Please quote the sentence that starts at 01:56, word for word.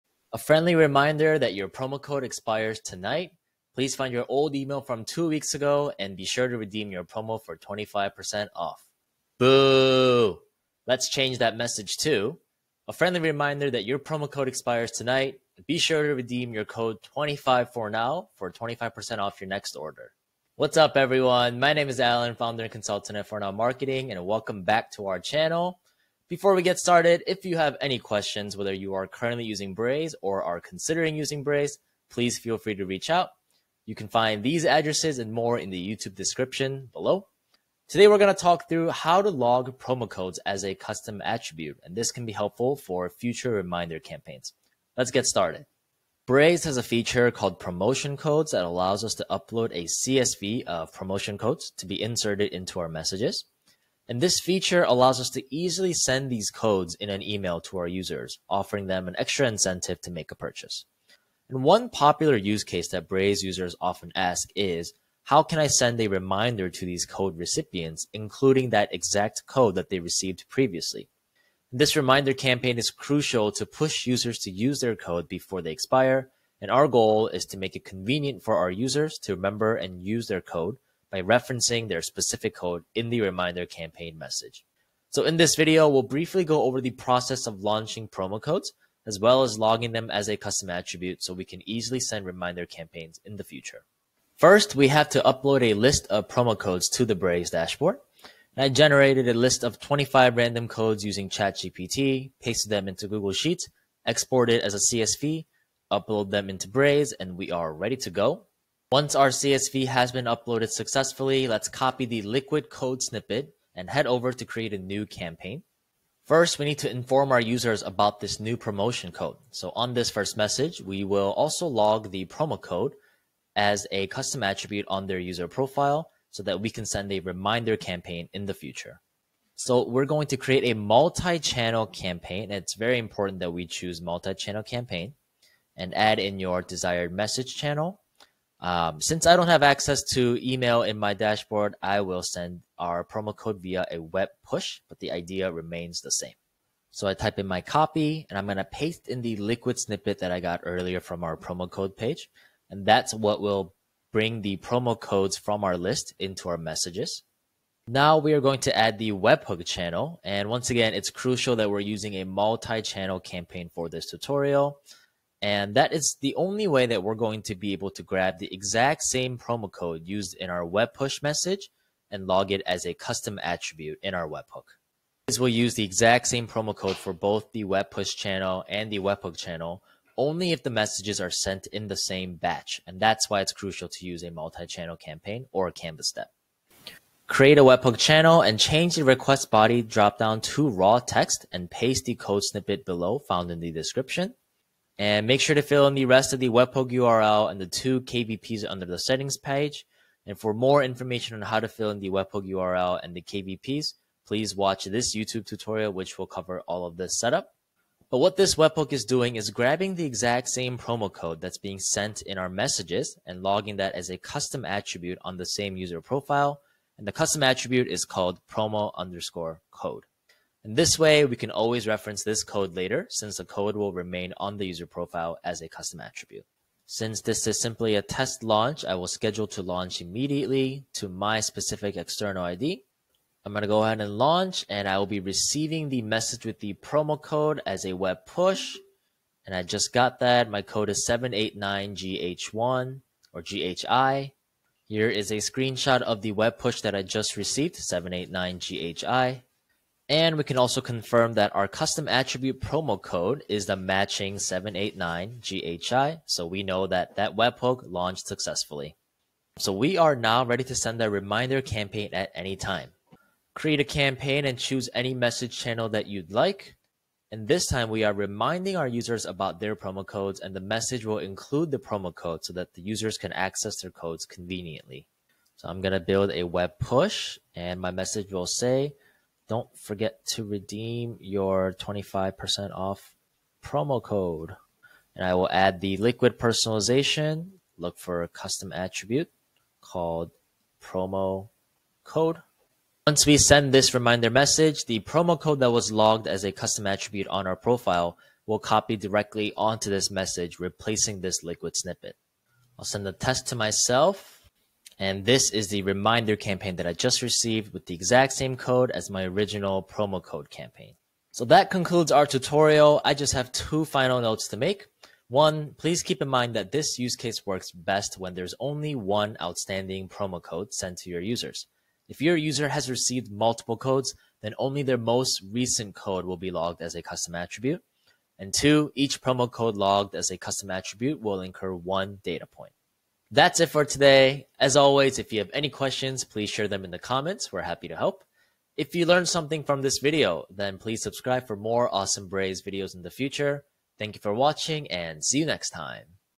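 First, we need to inform our users about this new promotion code.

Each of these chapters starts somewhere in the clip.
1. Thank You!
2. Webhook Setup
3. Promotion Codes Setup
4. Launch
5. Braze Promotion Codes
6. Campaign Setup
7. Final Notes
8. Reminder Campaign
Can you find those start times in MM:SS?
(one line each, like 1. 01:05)
1. 05:33
2. 02:38
3. 01:34
4. 03:46
5. 00:46
6. 01:56
7. 05:11
8. 04:23.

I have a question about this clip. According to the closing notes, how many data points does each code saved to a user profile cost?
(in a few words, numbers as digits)
1.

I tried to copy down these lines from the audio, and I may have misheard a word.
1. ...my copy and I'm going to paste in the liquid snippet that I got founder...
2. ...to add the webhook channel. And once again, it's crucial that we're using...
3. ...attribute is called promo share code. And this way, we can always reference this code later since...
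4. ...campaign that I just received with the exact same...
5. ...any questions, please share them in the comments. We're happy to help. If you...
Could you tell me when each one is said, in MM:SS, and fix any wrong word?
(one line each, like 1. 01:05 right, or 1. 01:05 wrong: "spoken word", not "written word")
1. 02:27 wrong: "earlier", not "founder"
2. 02:38 right
3. 03:37 wrong: "underscore", not "share"
4. 05:06 right
5. 05:35 right.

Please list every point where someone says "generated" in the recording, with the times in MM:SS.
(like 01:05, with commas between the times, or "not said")
01:38.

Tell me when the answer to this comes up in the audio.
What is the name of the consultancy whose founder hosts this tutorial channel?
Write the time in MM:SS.
00:23.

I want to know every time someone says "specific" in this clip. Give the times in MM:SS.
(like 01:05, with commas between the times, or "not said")
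01:22, 03:51.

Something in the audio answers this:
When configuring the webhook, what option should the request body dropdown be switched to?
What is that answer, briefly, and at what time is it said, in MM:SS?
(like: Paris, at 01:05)
raw text, at 03:10.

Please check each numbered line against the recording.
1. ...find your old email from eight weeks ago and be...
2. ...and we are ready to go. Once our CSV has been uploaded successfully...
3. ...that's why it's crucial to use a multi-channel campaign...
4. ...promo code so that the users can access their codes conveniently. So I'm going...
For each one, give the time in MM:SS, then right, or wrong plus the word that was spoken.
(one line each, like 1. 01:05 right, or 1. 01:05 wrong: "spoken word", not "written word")
1. 00:03 wrong: "two", not "eight"
2. 01:47 right
3. 03:02 right
4. 04:31 right.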